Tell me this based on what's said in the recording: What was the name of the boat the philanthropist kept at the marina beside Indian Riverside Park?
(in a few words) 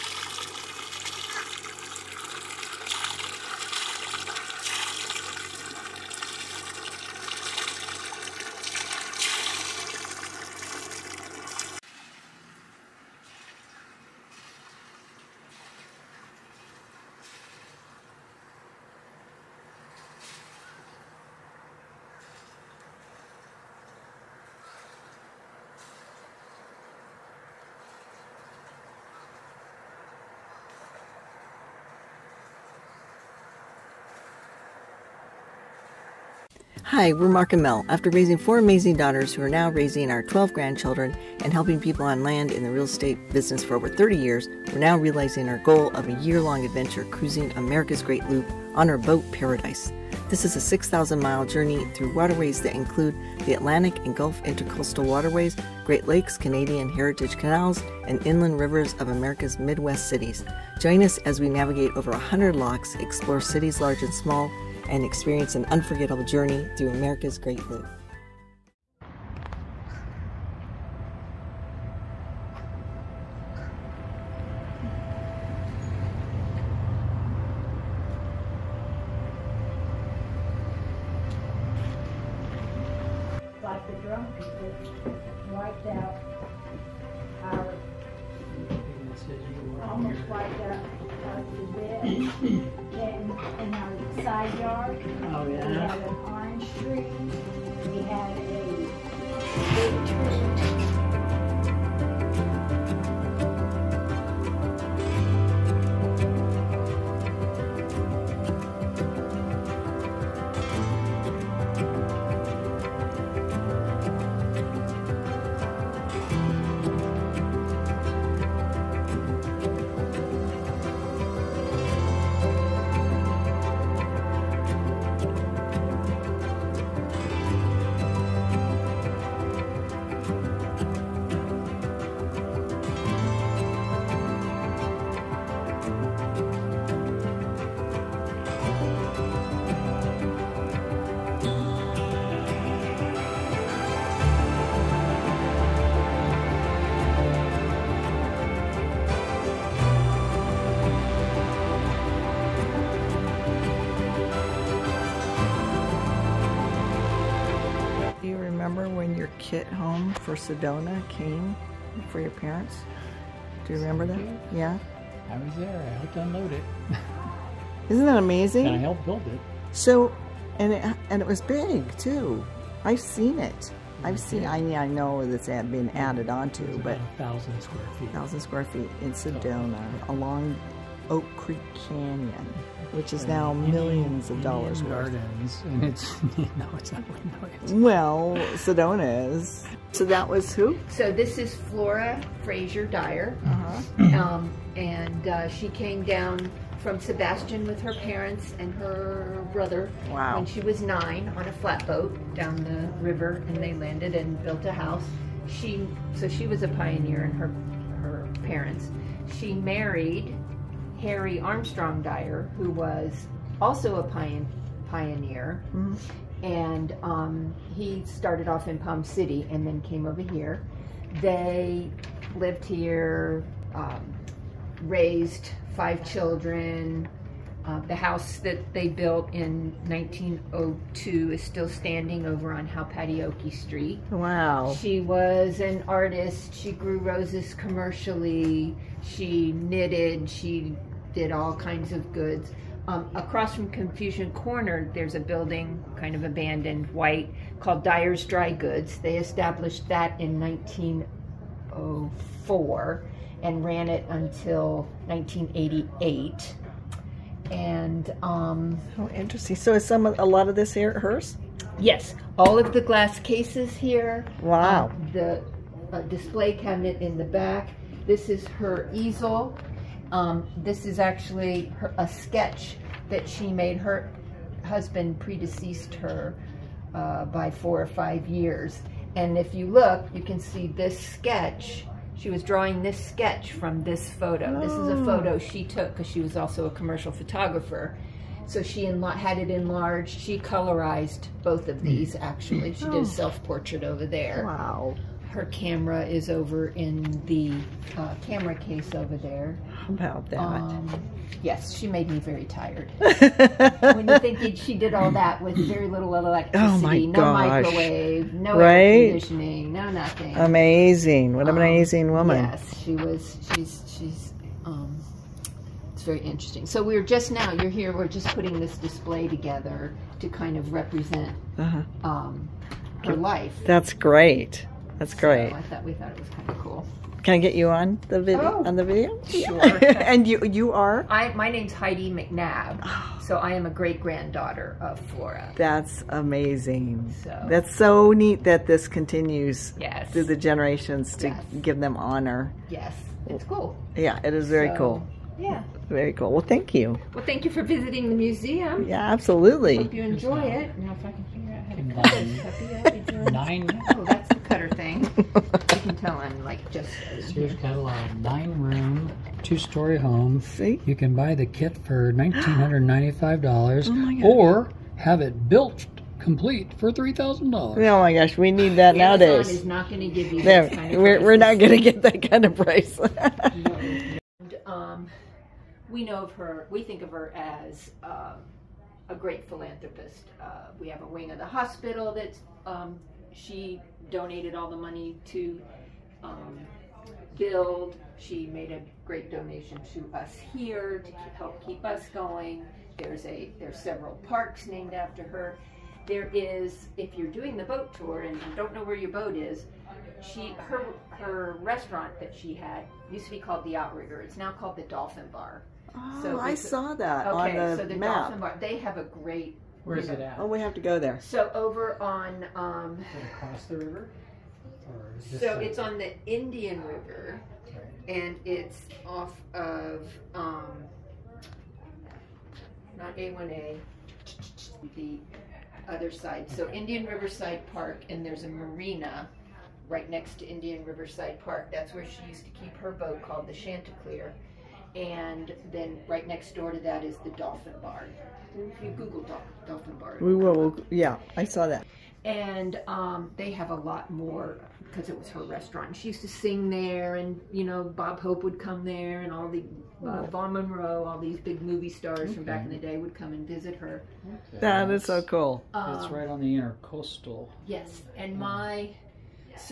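Chanticleer.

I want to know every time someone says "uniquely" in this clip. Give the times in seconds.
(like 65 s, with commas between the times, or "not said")
not said.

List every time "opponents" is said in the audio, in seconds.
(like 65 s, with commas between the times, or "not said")
not said.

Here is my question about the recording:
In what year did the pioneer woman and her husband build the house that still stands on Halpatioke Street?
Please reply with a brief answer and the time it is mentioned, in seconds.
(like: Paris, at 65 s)
1902, at 229 s.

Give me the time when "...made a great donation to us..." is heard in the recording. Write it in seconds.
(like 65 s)
388 s.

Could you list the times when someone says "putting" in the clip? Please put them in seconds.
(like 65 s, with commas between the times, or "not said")
318 s.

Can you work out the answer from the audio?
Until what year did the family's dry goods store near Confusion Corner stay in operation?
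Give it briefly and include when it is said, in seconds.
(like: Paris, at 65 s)
1988, at 255 s.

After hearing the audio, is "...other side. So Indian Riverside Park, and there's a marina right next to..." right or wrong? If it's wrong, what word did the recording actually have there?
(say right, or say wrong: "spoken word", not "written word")
right.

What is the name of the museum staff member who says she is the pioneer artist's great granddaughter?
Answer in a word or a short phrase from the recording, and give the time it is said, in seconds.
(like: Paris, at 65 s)
Heidi McNabb, at 331 s.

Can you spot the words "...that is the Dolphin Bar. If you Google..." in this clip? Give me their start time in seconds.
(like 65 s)
436 s.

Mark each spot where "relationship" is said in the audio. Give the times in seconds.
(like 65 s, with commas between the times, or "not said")
not said.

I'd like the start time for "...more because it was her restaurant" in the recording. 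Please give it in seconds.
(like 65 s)
444 s.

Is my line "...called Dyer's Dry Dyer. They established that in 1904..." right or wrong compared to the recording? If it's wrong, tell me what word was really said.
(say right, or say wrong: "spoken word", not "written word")
wrong: "Goods", not "Dyer".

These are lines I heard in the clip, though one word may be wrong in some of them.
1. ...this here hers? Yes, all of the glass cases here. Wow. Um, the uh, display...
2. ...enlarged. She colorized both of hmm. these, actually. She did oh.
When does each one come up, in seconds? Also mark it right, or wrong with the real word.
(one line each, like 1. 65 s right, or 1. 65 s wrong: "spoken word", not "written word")
1. 260 s right
2. 289 s right.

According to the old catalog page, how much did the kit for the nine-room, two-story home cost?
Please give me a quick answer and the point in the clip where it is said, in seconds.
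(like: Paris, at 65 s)
$1,995, at 362 s.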